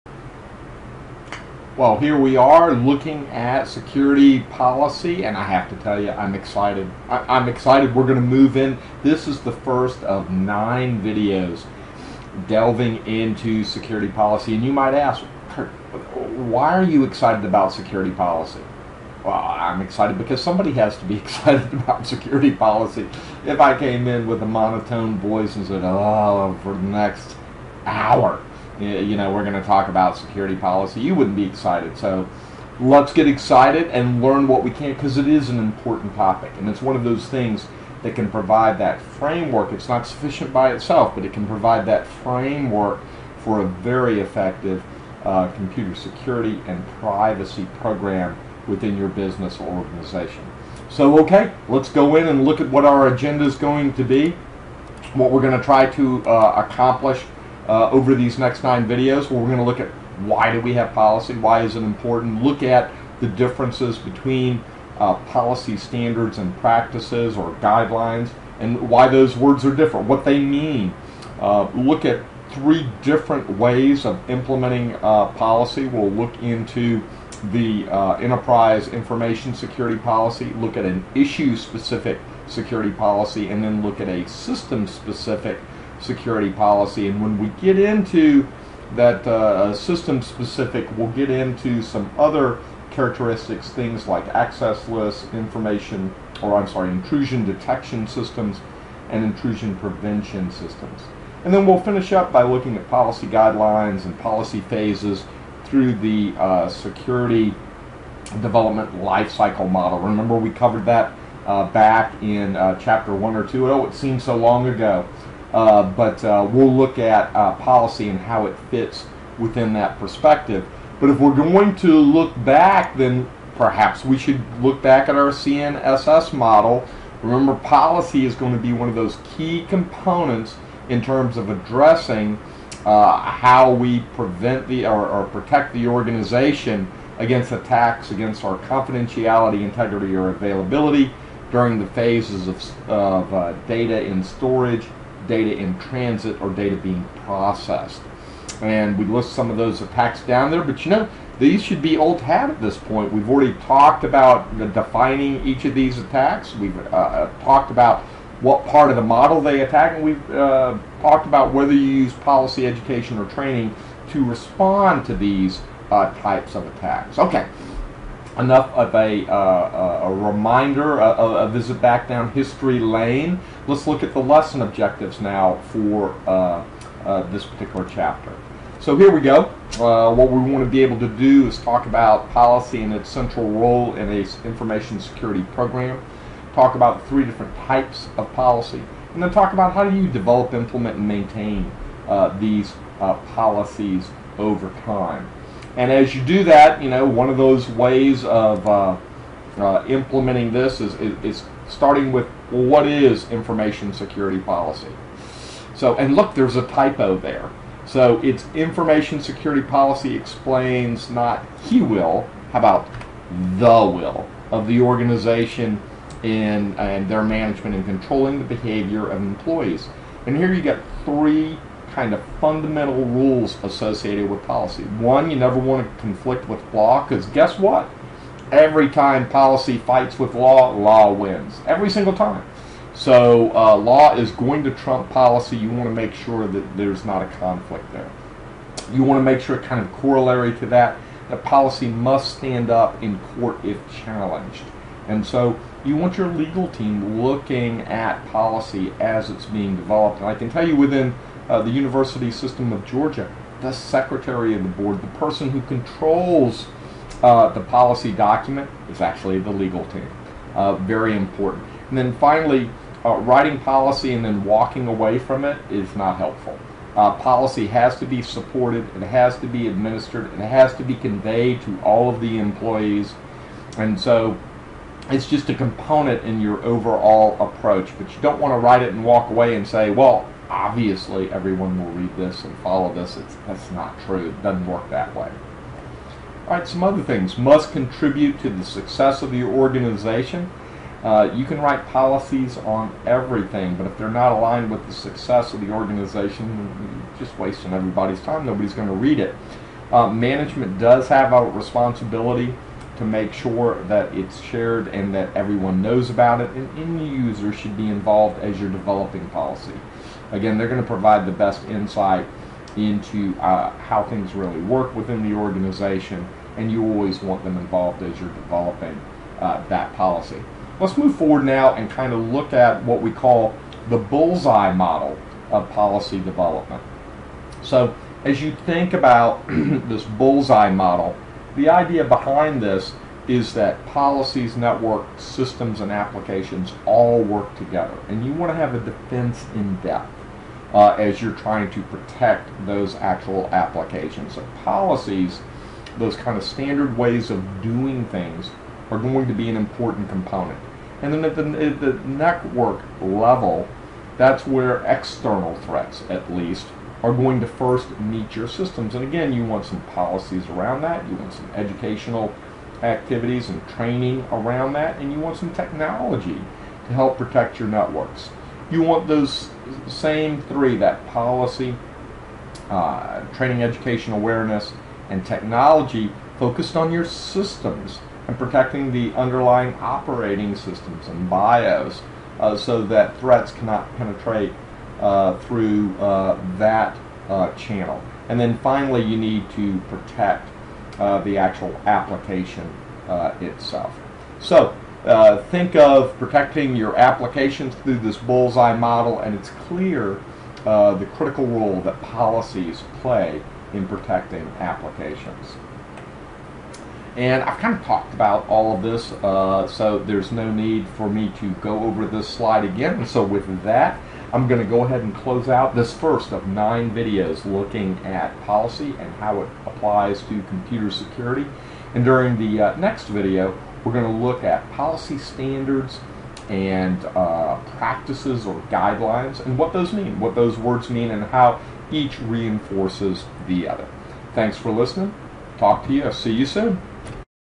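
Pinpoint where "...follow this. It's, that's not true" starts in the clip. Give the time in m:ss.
4:42.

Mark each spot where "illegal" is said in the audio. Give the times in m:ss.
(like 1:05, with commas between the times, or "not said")
not said.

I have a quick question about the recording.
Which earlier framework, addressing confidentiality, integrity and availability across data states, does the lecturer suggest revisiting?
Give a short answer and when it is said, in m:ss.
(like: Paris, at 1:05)
CNSS model, at 2:05.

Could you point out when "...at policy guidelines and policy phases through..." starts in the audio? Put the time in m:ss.
1:42.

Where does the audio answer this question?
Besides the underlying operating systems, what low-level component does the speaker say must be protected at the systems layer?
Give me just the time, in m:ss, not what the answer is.
6:21.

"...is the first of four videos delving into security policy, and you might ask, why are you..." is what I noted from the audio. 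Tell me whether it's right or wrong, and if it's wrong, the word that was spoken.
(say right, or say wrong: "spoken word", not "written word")
wrong: "nine", not "four".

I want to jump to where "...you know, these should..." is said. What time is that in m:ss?
2:30.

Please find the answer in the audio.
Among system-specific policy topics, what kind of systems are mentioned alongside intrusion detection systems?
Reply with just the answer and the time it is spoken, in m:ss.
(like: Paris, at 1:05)
Intrusion prevention systems, at 1:39.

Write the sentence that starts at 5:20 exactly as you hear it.
Let's move forward now and kind of look at what we call the bullseye model of policy development.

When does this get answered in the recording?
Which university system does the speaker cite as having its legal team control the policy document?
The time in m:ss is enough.
4:11.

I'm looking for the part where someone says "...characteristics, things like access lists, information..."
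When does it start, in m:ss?
1:32.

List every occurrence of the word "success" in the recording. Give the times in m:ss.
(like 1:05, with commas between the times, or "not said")
4:48, 4:54.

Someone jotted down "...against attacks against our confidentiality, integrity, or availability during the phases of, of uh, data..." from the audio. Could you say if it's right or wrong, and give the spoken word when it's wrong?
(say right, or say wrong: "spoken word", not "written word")
right.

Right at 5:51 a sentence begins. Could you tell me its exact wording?
And then at the, at the network level, that's where external threats, at least, are going to first meet your systems.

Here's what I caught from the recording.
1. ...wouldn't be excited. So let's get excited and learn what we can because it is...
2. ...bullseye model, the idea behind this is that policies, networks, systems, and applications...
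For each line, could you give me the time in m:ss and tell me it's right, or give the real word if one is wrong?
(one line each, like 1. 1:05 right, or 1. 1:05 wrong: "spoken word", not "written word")
1. 0:31 right
2. 5:30 right.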